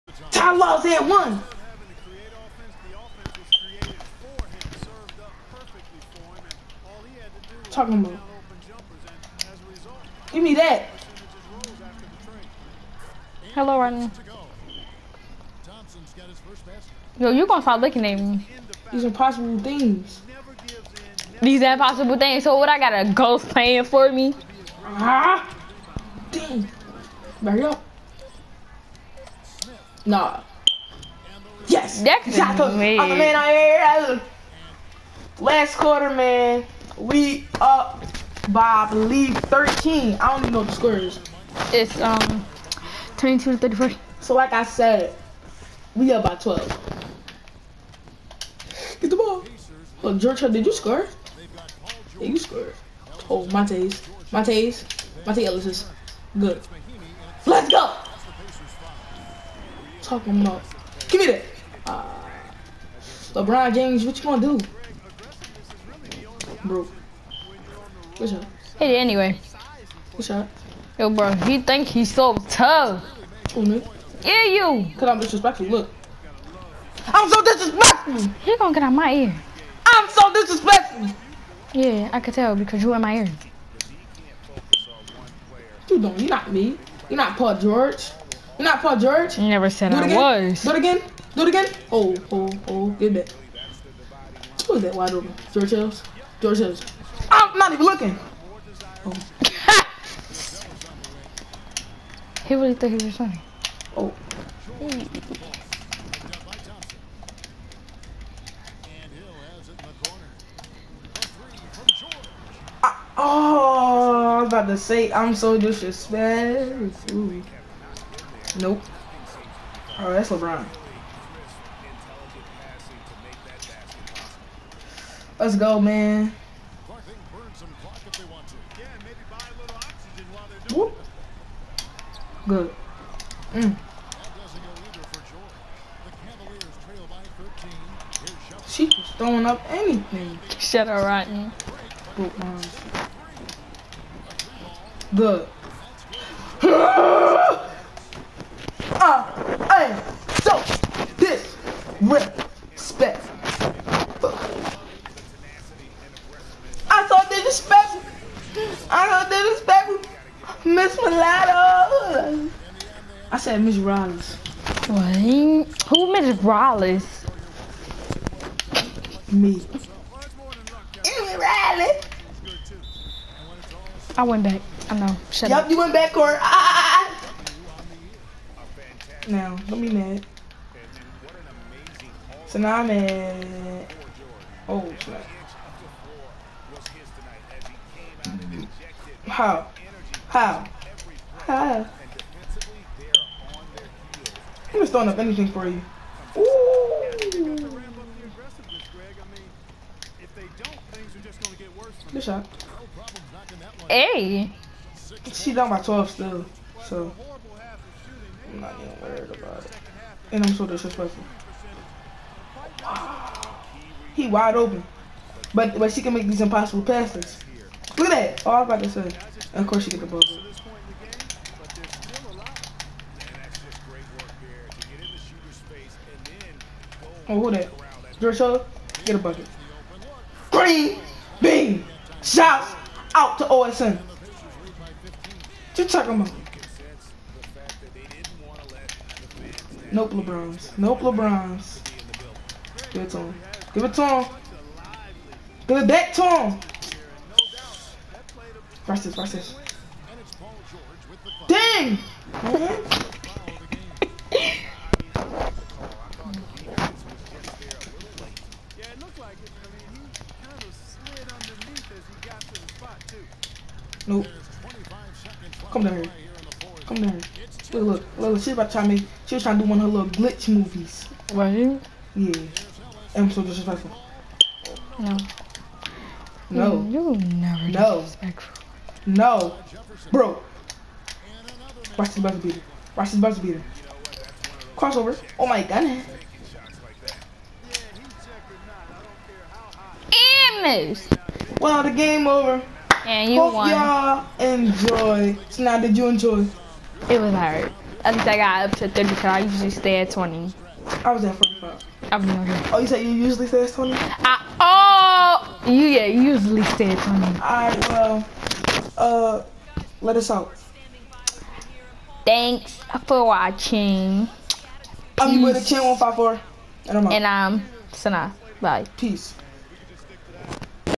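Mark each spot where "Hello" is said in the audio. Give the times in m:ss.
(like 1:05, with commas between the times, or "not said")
0:13.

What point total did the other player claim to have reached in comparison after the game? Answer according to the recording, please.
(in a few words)
45.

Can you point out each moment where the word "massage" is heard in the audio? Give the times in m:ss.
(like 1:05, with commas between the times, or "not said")
not said.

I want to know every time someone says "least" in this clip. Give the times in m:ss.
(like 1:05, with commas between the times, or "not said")
4:58.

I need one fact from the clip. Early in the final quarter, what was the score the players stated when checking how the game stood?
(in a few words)
22 to 34.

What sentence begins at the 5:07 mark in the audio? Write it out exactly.
All right, well, uh, let us out.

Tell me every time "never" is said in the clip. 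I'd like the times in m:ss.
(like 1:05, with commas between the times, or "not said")
1:29, 4:37.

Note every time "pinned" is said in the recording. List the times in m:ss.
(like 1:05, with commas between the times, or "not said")
not said.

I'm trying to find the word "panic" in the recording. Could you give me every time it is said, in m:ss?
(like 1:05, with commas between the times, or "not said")
not said.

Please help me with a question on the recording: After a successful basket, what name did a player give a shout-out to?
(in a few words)
OSN.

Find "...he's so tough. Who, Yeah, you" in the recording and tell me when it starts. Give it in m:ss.
1:11.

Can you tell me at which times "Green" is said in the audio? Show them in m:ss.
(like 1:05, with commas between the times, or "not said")
3:50.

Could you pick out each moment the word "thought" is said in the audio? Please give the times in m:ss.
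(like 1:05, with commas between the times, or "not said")
1:42.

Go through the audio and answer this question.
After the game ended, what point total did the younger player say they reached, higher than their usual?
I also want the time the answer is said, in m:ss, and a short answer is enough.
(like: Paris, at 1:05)
35, at 4:58.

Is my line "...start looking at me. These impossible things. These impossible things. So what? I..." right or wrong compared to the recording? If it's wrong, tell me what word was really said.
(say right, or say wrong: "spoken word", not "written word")
right.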